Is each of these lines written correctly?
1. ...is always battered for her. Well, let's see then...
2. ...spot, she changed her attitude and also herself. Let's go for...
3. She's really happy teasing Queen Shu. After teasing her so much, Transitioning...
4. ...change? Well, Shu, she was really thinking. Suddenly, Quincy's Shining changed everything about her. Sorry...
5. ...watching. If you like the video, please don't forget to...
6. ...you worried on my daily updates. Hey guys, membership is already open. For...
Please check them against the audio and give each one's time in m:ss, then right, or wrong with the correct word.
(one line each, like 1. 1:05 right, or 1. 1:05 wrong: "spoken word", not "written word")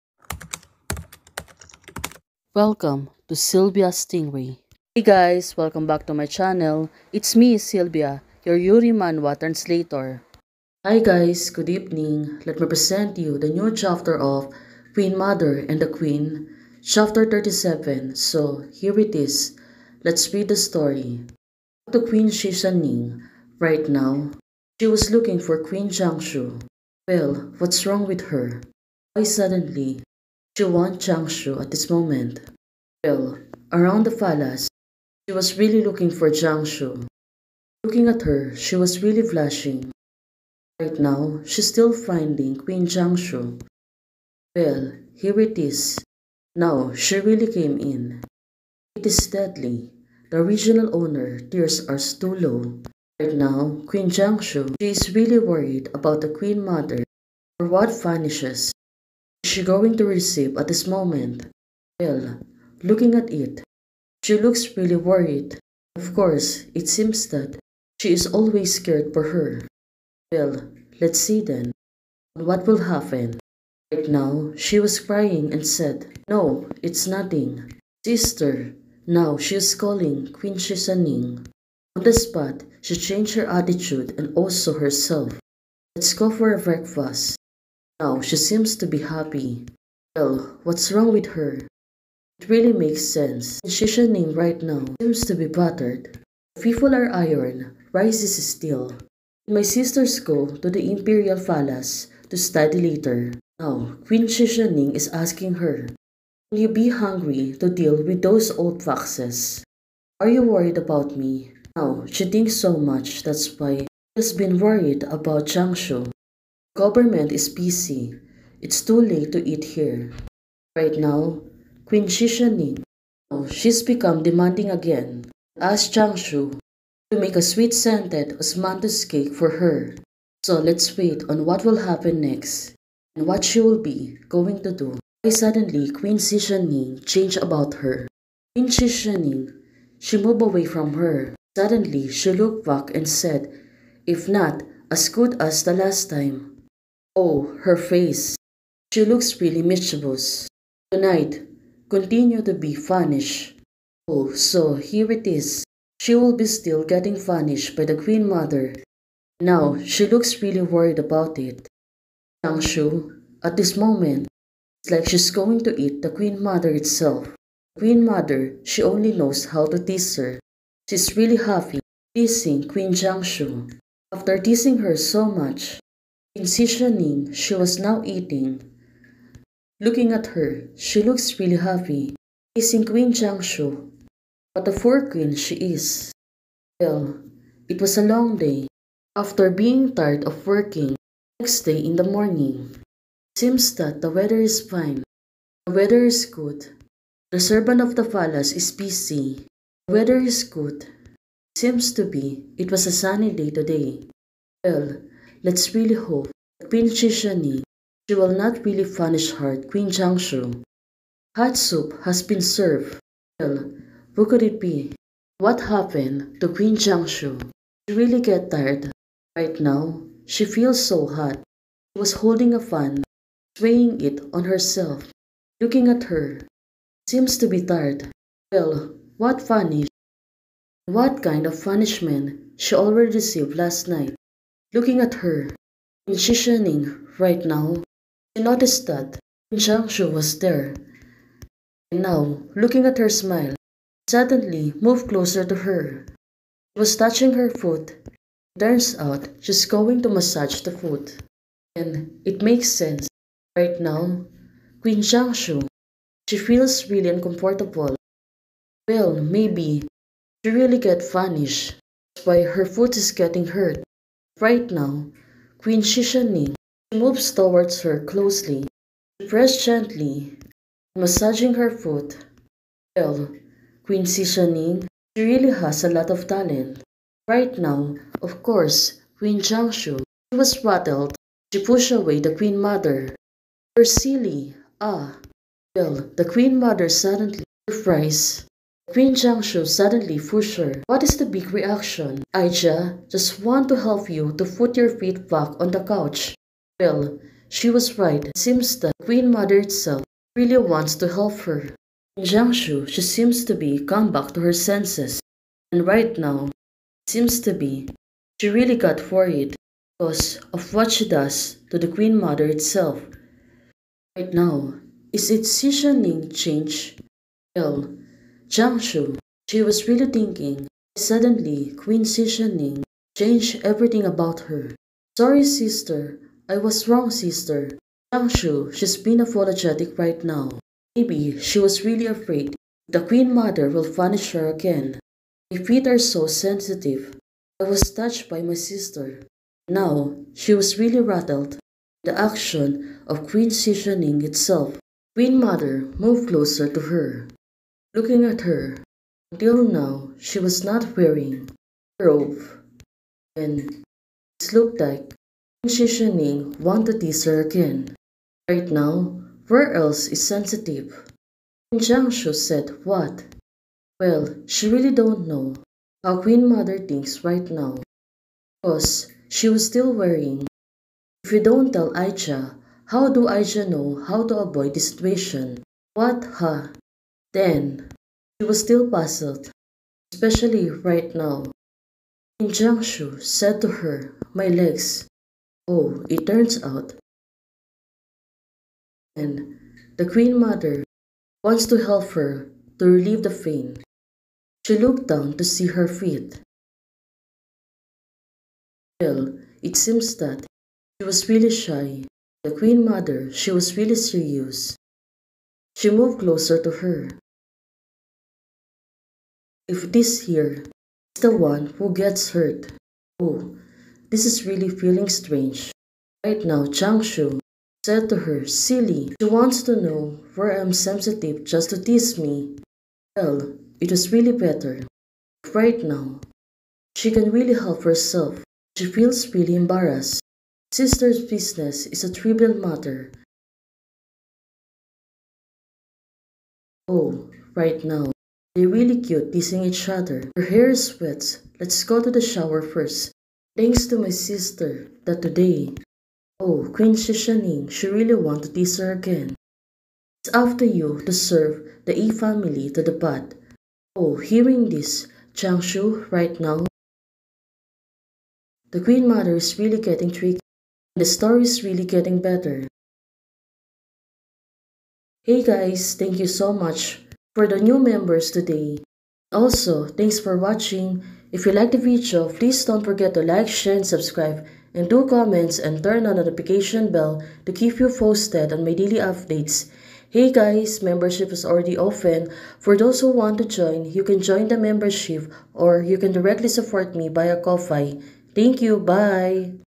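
1. 1:08 wrong: "scared", not "battered"
2. 1:22 right
3. 2:50 right
4. 5:16 right
5. 7:50 right
6. 7:57 wrong: "posted", not "worried".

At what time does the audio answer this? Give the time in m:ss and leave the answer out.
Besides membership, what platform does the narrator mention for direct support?
8:07.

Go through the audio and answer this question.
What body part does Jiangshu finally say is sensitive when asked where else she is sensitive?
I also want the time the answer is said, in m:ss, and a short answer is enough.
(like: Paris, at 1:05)
legs, at 6:24.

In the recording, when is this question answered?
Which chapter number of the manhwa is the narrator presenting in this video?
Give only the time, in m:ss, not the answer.
0:16.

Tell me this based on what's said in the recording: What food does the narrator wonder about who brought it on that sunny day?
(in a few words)
Hot soup.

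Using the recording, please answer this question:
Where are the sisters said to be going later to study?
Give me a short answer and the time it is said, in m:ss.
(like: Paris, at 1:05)
Imperial Palace, at 1:40.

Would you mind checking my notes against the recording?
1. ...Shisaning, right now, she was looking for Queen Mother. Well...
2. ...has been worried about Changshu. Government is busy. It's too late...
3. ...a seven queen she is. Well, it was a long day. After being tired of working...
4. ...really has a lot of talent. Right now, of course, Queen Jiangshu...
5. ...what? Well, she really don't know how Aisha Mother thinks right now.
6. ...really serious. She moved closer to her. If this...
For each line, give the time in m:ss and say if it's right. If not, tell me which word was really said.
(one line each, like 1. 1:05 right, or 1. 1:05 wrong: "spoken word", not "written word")
1. 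0:22 wrong: "Jiangshu", not "Mother"
2. 1:54 right
3. 3:04 wrong: "four", not "seven"
4. 4:35 right
5. 6:02 wrong: "Queen", not "Aisha"
6. 6:43 right.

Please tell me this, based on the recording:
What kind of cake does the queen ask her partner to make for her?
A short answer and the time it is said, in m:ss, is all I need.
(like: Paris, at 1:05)
sweet-scented osmanthus cake, at 2:07.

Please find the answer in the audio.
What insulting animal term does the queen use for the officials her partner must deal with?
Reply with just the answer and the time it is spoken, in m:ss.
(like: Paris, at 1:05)
old foxes, at 1:48.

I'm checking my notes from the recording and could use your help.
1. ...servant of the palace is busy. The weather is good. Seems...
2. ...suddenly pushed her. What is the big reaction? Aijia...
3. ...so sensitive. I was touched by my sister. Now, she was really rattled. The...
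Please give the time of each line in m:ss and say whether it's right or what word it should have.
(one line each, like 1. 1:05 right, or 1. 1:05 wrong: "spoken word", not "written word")
1. 3:17 right
2. 4:49 right
3. 5:35 right.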